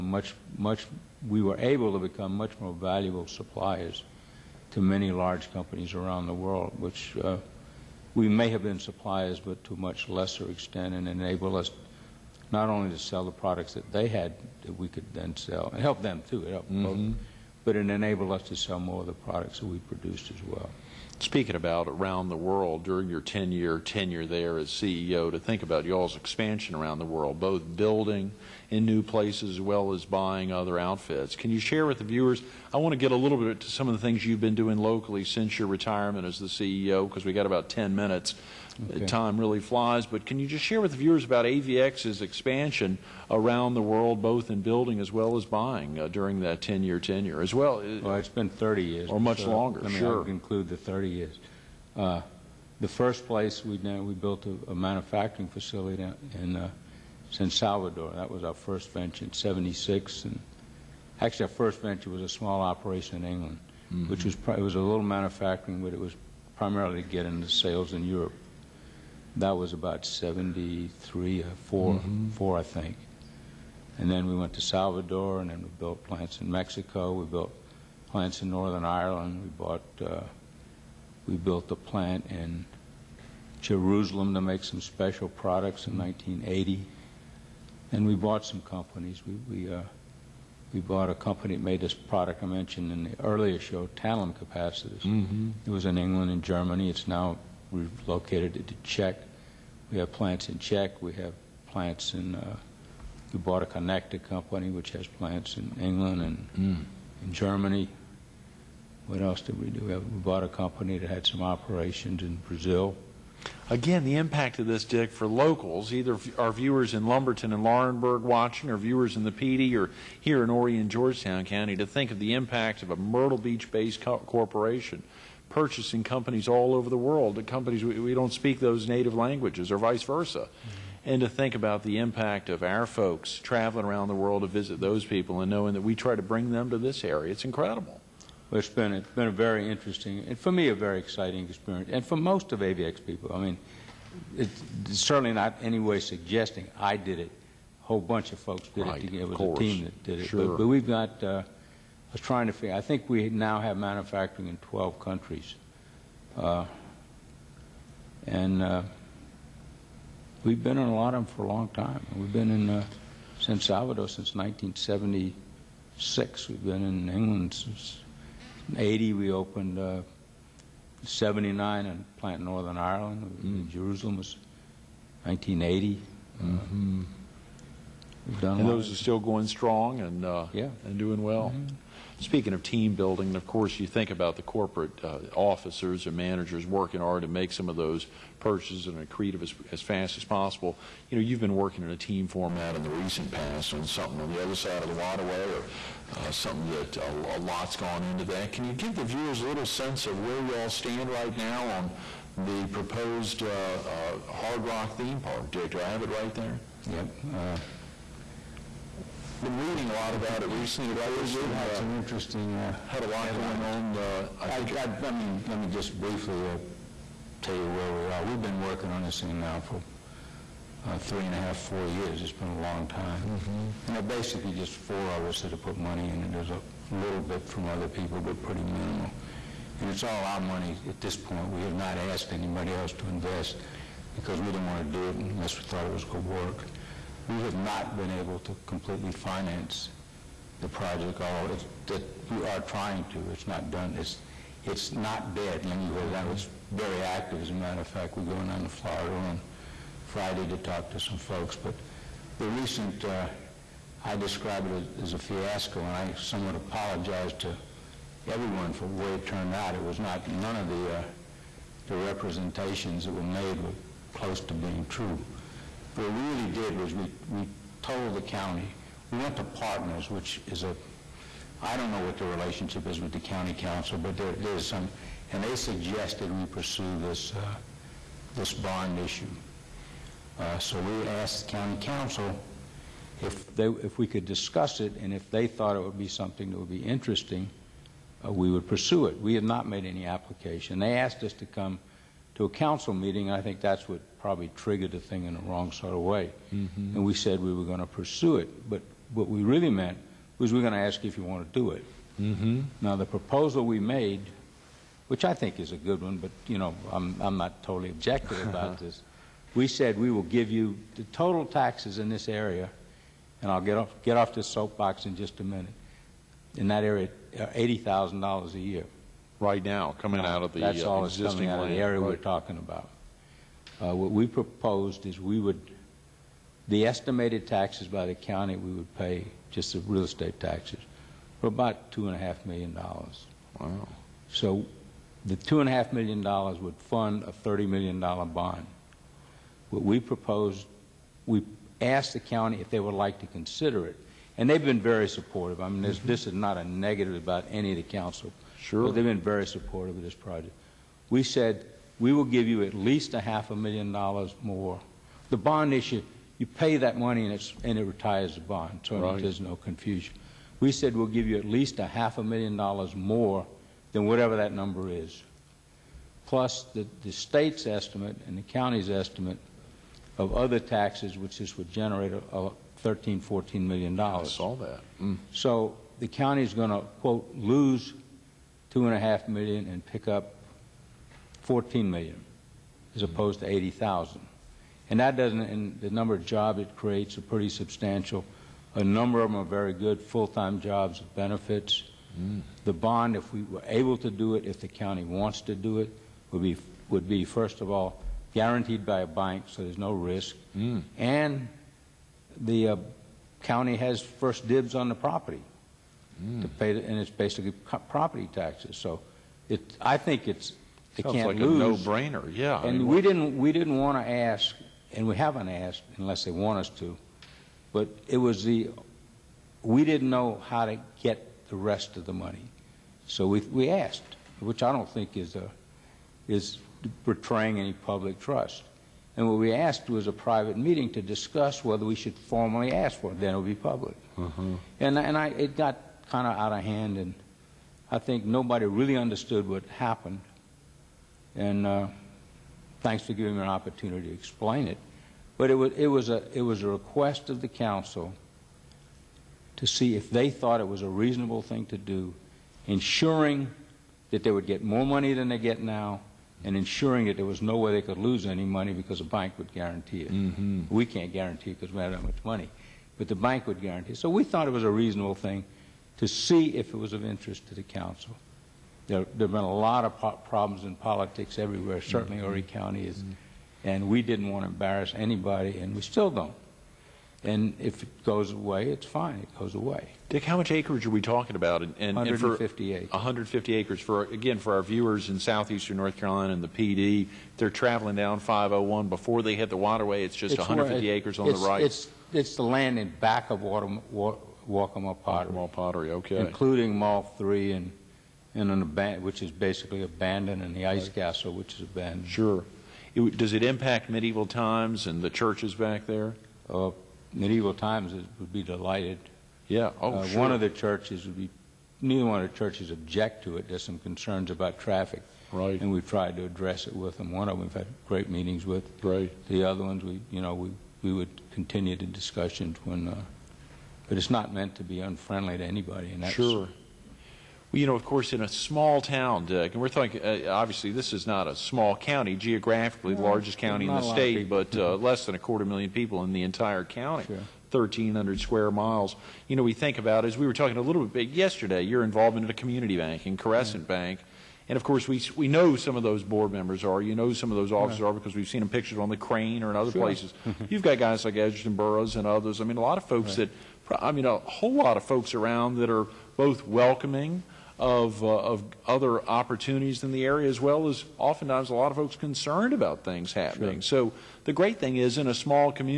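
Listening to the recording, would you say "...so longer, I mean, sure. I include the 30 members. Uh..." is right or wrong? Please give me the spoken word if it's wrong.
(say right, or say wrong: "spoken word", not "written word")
wrong: "years", not "members".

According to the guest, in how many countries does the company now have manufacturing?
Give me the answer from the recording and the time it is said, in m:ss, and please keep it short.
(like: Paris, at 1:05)
12, at 2:34.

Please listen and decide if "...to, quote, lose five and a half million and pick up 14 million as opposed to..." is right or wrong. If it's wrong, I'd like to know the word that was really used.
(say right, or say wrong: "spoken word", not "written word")
wrong: "two", not "five".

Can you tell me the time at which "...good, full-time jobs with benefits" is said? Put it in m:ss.
6:29.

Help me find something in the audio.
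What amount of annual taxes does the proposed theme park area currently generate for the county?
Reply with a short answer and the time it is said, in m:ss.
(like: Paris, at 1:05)
$80,000, at 5:18.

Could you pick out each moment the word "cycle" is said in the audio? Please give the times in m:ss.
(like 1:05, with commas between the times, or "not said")
not said.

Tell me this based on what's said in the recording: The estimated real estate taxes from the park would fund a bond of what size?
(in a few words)
$30 million.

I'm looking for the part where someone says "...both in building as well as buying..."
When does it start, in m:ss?
0:44.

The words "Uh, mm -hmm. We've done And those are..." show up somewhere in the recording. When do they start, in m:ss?
2:56.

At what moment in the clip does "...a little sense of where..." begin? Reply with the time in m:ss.
3:19.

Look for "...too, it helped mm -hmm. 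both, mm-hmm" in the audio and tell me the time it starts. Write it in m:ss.
0:16.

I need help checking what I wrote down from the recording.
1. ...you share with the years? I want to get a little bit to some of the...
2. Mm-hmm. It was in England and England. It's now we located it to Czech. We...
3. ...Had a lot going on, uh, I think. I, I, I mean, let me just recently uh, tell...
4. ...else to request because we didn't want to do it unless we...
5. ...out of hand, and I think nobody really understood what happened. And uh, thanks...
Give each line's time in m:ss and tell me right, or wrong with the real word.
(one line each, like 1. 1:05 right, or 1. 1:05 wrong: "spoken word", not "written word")
1. 0:31 wrong: "viewers", not "years"
2. 1:35 wrong: "Germany", not "England"
3. 3:32 wrong: "briefly", not "recently"
4. 3:52 wrong: "invest", not "request"
5. 7:16 right.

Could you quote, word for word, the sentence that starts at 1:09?
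That was about 73 or 4, mm-hmm.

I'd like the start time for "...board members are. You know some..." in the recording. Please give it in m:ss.
9:06.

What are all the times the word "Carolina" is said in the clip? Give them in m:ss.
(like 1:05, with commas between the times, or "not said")
8:05.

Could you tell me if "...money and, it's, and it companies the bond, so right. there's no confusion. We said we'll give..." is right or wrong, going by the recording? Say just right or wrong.
wrong.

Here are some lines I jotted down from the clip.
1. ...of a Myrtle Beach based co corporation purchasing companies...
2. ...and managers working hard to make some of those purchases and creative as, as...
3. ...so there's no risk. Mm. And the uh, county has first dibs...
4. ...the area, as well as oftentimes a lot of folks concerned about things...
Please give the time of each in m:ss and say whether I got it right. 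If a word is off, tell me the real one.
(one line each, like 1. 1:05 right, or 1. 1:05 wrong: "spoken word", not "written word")
1. 2:02 right
2. 3:06 right
3. 6:39 right
4. 9:19 right.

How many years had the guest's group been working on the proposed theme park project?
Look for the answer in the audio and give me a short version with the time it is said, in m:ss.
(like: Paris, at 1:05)
three and a half, four years, at 3:40.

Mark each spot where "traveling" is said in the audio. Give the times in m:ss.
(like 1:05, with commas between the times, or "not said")
2:13, 8:07.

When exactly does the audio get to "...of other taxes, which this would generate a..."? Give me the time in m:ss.
6:10.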